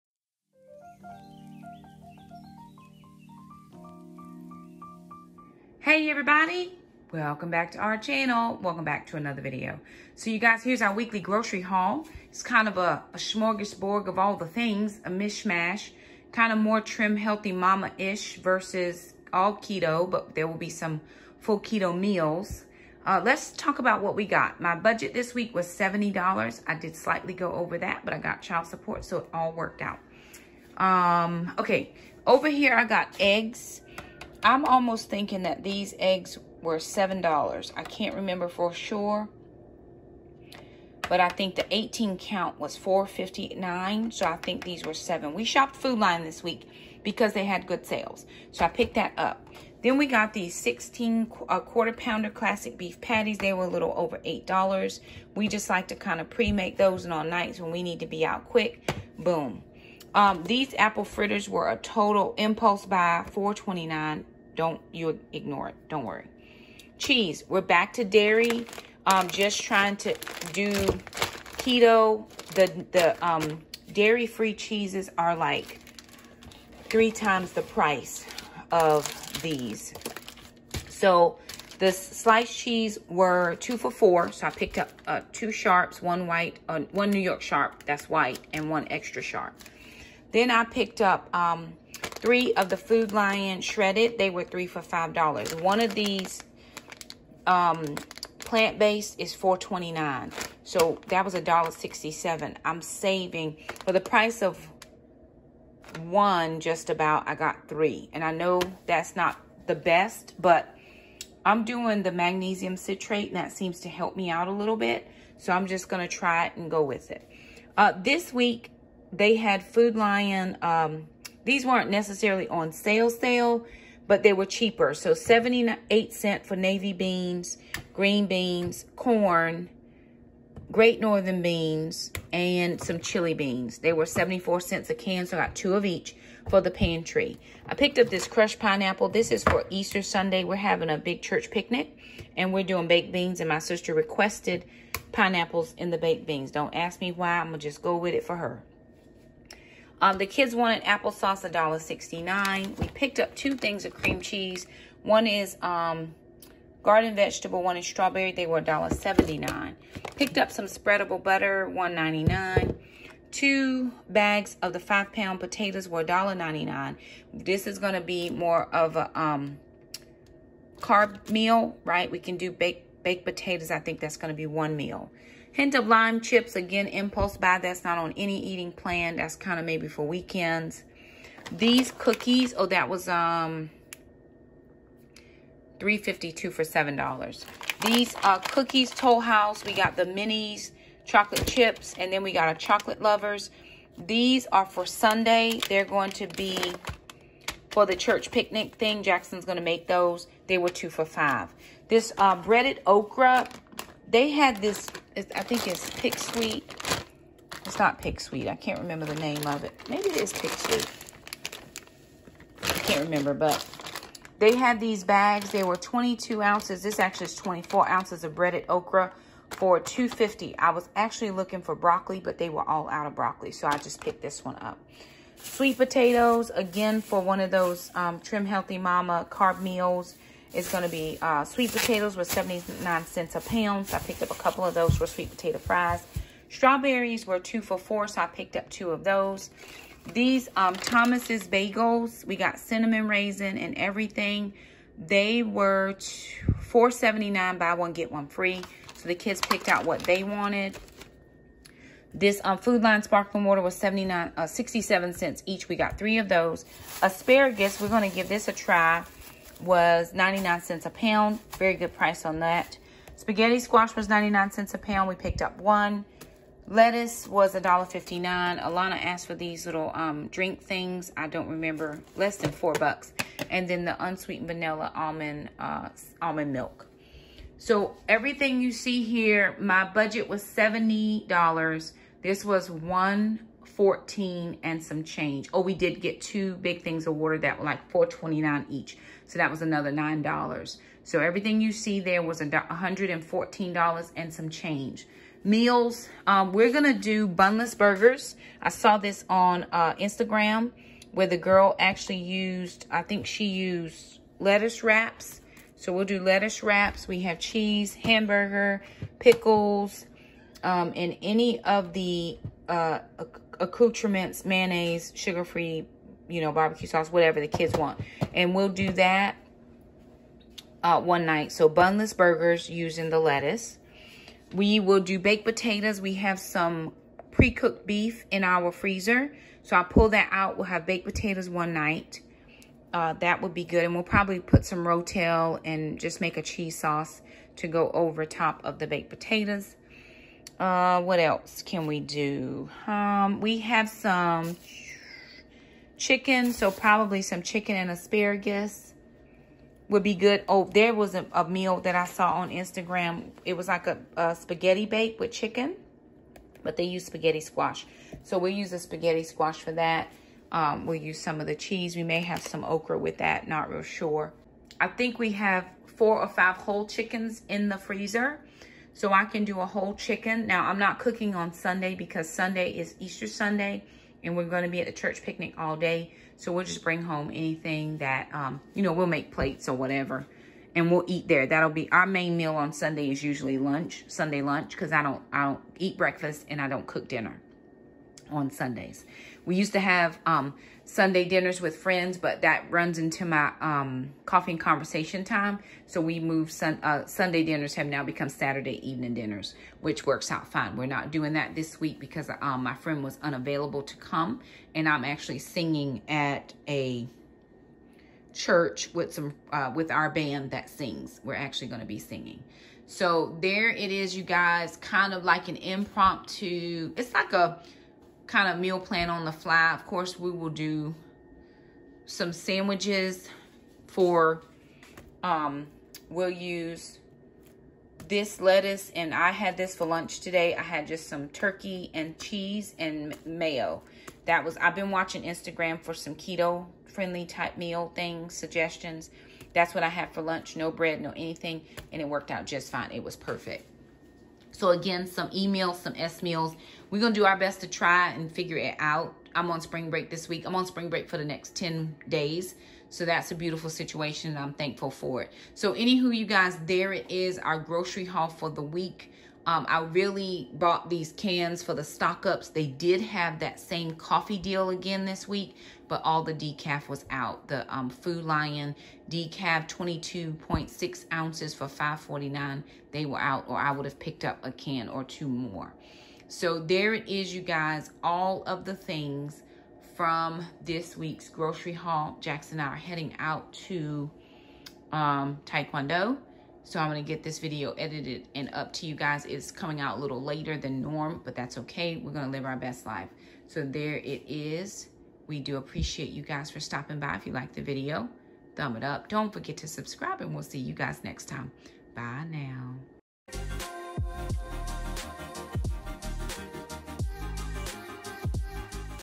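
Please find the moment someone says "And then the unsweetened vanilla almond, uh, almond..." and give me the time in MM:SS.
04:33.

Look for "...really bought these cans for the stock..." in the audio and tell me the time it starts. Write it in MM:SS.
07:39.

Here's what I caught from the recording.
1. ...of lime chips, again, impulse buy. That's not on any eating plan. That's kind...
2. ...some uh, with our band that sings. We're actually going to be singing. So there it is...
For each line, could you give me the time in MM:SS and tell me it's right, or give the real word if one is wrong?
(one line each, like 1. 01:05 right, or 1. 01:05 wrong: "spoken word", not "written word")
1. 02:55 right
2. 06:49 right.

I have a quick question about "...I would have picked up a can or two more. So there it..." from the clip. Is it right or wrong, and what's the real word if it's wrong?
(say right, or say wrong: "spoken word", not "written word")
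right.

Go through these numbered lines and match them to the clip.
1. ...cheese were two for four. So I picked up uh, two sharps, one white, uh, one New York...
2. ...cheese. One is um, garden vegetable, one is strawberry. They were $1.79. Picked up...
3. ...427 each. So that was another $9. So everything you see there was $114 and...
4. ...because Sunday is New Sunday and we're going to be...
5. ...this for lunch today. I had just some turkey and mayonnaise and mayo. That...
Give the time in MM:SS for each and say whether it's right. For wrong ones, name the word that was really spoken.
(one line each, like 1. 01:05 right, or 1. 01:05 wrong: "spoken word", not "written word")
1. 01:22 right
2. 02:34 right
3. 04:47 wrong: "429", not "427"
4. 06:11 wrong: "Easter", not "New"
5. 07:09 wrong: "cheese", not "mayonnaise".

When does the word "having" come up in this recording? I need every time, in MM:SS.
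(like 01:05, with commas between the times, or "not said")
02:20.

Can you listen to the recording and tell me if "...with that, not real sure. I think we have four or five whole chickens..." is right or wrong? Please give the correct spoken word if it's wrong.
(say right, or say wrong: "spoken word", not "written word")
right.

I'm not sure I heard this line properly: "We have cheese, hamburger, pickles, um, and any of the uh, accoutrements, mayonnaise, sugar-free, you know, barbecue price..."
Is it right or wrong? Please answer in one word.
wrong.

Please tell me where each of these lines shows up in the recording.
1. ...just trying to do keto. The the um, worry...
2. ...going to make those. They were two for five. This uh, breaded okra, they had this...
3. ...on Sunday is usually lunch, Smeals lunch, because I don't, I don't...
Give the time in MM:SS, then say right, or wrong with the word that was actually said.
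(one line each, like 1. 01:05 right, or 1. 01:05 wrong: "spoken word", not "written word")
1. 01:09 wrong: "dairy", not "worry"
2. 03:19 right
3. 06:22 wrong: "Sunday", not "Smeals".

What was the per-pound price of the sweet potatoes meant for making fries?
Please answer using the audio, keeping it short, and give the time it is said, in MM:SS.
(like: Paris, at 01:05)
79 cents, at 03:52.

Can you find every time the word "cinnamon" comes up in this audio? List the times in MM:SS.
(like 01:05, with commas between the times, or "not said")
04:02.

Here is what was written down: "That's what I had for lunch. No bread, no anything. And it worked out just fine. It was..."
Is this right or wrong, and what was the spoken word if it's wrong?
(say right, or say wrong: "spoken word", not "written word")
right.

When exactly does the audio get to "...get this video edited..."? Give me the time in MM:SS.
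08:07.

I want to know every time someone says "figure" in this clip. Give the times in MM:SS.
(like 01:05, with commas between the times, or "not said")
07:28.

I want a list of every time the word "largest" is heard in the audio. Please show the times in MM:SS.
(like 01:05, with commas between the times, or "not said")
not said.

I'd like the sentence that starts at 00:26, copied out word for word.
I did slightly go over that, but I got child support, so it all worked out.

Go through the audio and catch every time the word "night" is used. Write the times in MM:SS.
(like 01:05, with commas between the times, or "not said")
00:57, 05:21, 05:31.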